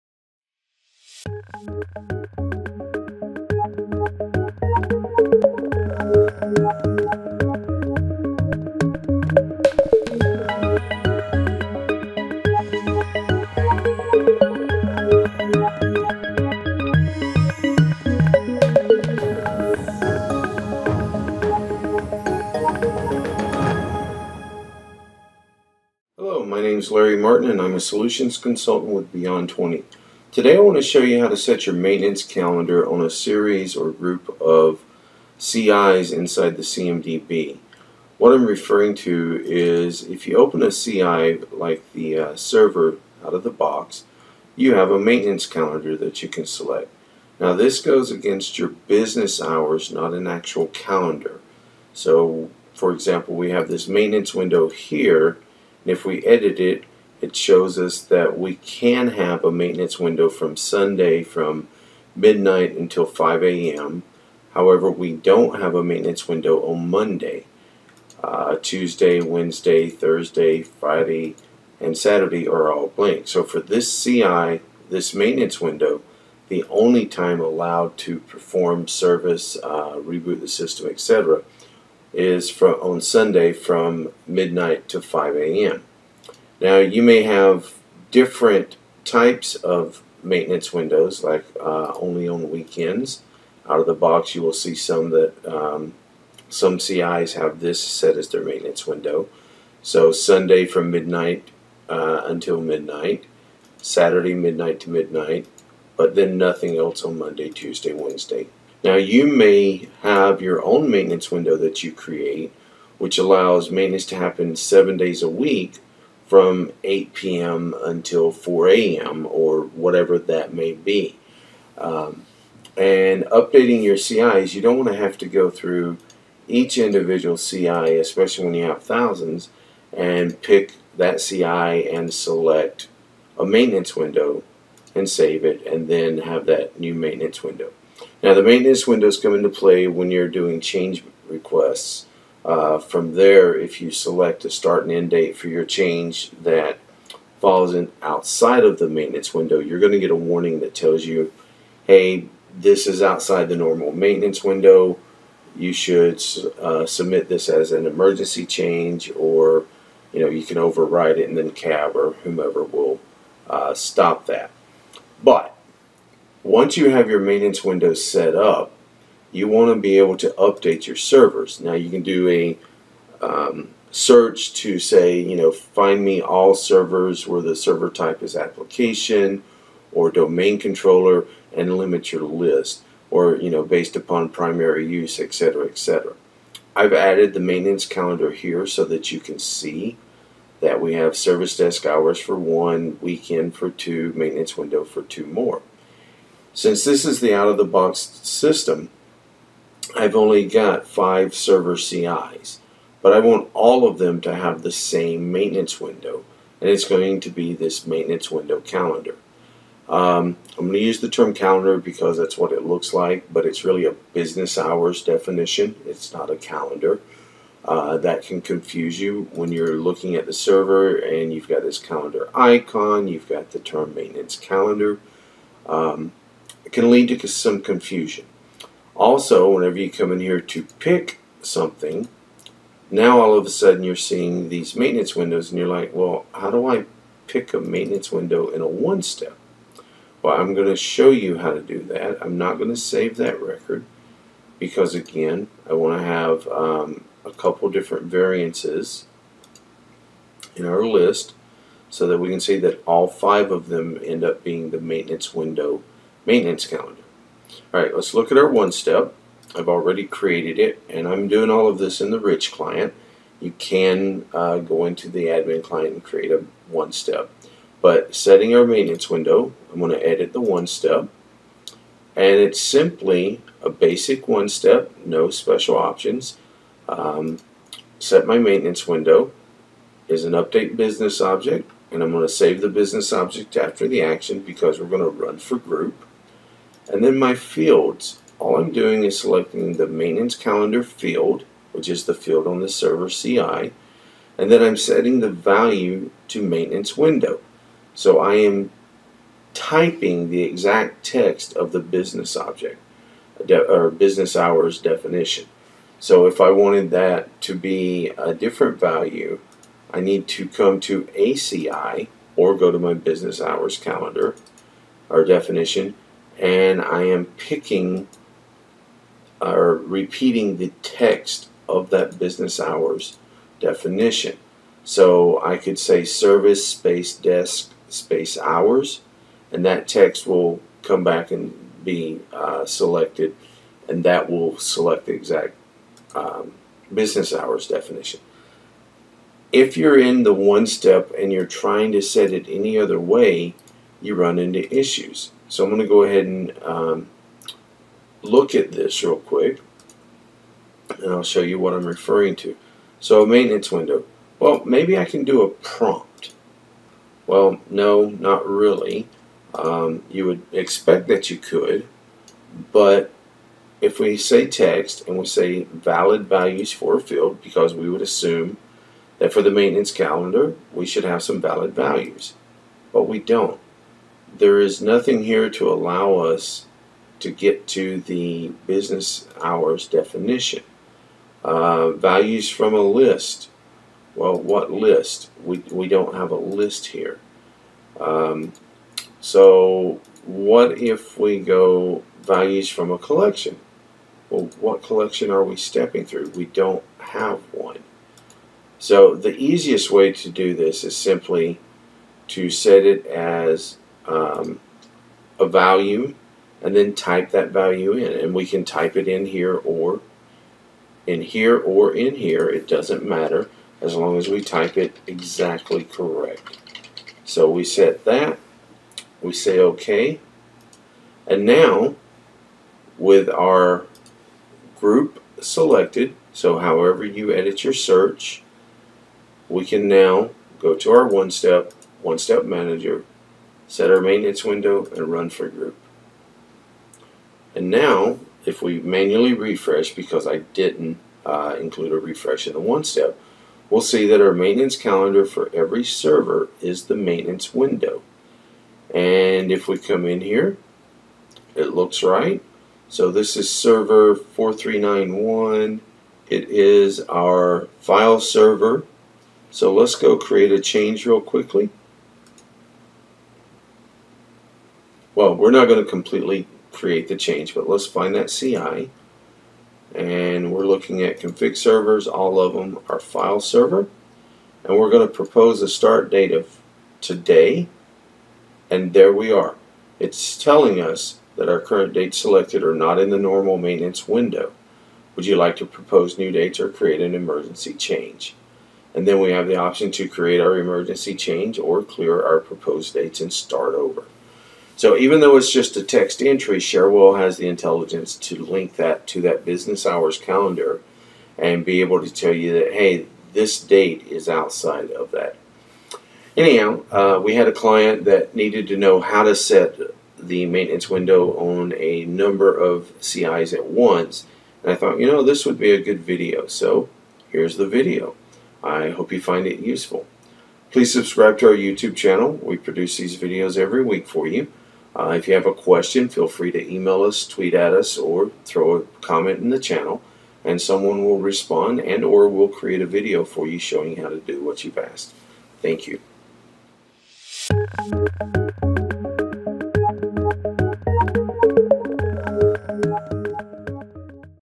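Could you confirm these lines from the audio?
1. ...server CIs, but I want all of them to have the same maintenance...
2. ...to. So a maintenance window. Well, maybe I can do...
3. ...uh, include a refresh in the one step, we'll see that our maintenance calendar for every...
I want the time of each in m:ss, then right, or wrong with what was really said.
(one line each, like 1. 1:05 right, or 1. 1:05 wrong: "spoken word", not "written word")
1. 3:21 right
2. 5:52 right
3. 7:21 right.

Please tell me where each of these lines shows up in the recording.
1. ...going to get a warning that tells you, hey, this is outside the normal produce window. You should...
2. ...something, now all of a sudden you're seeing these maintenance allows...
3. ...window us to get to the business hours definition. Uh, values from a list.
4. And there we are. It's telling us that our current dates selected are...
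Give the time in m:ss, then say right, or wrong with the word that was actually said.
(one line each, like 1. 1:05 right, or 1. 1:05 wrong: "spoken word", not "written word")
1. 2:29 wrong: "maintenance", not "produce"
2. 3:51 wrong: "windows", not "allows"
3. 6:15 wrong: "allow", not "window"
4. 7:58 right.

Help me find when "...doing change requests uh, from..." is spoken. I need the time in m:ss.
2:20.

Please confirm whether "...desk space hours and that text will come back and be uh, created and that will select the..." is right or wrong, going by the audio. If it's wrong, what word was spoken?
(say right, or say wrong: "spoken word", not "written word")
wrong: "selected", not "created".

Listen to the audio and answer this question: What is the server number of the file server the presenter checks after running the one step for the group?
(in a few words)
4391.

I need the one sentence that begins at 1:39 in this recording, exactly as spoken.
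So Sunday from midnight uh, until midnight, Saturday midnight to midnight, but then nothing else on Monday, Tuesday, Wednesday.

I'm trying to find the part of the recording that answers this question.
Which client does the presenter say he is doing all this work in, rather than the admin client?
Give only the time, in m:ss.
4:22.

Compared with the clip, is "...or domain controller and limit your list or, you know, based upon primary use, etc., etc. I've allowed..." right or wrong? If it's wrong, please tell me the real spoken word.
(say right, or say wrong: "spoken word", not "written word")
wrong: "added", not "allowed".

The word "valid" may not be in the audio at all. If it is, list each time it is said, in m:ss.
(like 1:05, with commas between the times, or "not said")
6:05, 6:11.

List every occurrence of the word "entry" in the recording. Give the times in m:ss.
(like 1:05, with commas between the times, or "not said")
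8:16.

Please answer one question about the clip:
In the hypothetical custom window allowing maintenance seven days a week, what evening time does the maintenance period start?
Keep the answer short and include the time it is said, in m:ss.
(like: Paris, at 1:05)
8 p.m., at 1:56.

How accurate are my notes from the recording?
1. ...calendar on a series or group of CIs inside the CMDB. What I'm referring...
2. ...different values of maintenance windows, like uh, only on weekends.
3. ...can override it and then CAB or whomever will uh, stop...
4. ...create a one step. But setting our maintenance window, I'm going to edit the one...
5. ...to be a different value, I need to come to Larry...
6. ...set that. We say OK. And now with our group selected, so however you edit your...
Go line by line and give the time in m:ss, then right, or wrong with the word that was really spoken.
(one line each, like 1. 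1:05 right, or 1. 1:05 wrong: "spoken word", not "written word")
1. 0:32 right
2. 1:28 wrong: "types", not "values"
3. 2:40 right
4. 4:26 right
5. 5:07 wrong: "ACI", not "Larry"
6. 6:57 right.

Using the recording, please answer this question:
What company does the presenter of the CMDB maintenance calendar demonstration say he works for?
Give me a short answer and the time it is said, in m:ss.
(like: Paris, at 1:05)
Beyond 20, at 0:29.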